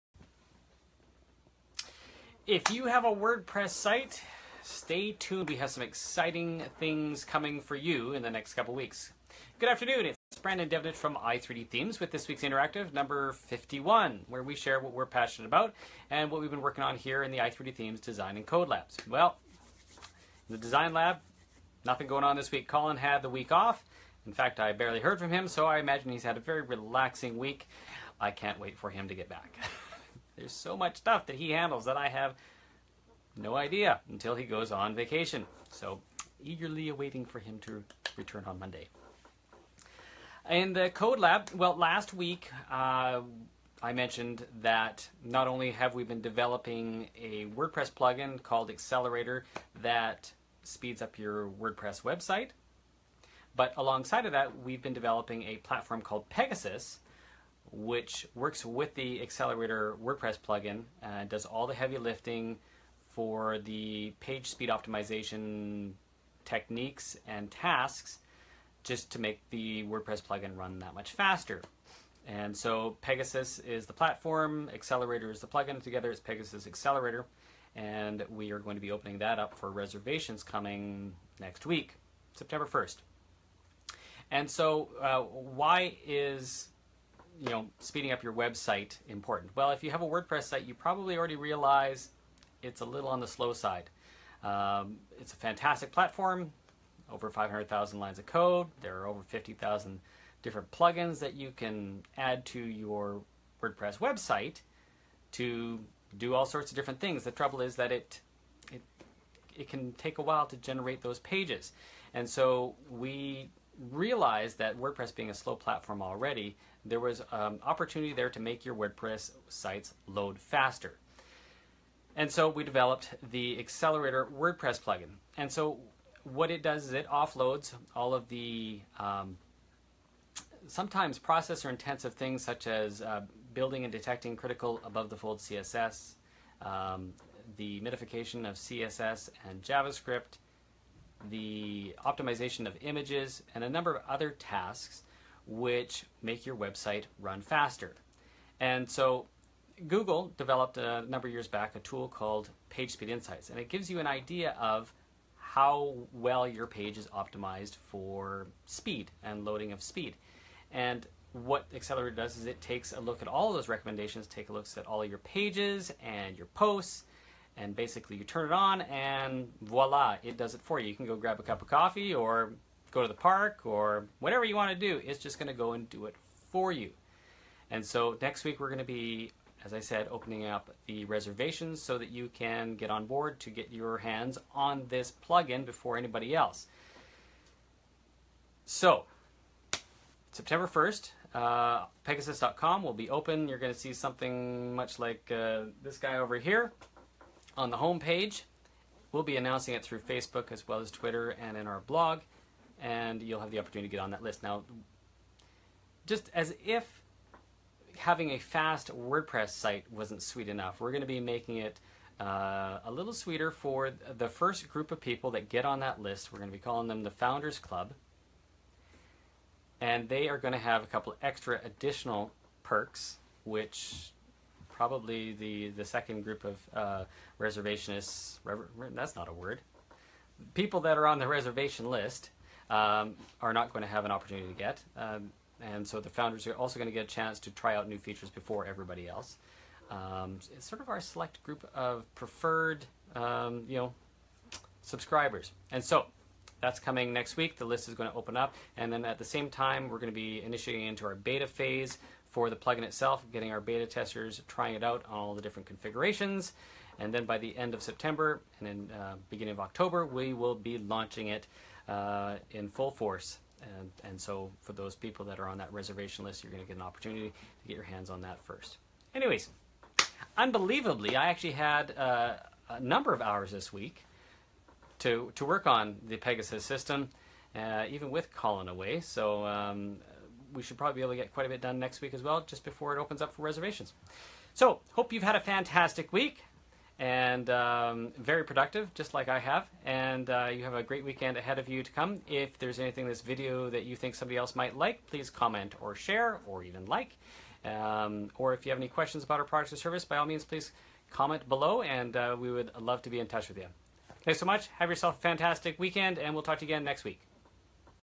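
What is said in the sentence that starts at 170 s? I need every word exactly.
You can go grab a cup of coffee or go to the park or whatever you want to do.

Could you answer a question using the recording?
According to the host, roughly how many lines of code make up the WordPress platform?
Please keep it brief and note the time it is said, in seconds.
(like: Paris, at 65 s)
500,000, at 97 s.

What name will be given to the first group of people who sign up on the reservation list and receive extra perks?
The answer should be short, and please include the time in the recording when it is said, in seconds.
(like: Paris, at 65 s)
Founders Club, at 217 s.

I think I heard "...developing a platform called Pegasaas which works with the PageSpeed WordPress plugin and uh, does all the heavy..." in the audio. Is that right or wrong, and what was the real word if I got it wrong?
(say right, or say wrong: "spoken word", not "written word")
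wrong: "Accelerator", not "PageSpeed".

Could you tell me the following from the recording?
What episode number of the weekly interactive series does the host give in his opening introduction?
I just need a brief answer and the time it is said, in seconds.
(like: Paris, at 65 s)
51, at 12 s.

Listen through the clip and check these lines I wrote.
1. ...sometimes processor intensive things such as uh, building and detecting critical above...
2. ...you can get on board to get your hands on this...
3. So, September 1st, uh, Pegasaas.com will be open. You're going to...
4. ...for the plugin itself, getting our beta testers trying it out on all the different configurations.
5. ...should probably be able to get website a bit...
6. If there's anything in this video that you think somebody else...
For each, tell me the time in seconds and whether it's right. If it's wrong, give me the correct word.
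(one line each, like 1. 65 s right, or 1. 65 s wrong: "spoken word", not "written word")
1. 130 s right
2. 182 s right
3. 188 s right
4. 252 s right
5. 280 s wrong: "quite", not "website"
6. 292 s right.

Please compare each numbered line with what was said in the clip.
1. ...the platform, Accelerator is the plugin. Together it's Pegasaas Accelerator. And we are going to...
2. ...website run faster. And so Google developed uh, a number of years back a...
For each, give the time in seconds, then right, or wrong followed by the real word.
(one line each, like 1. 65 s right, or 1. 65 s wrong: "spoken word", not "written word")
1. 73 s right
2. 146 s right.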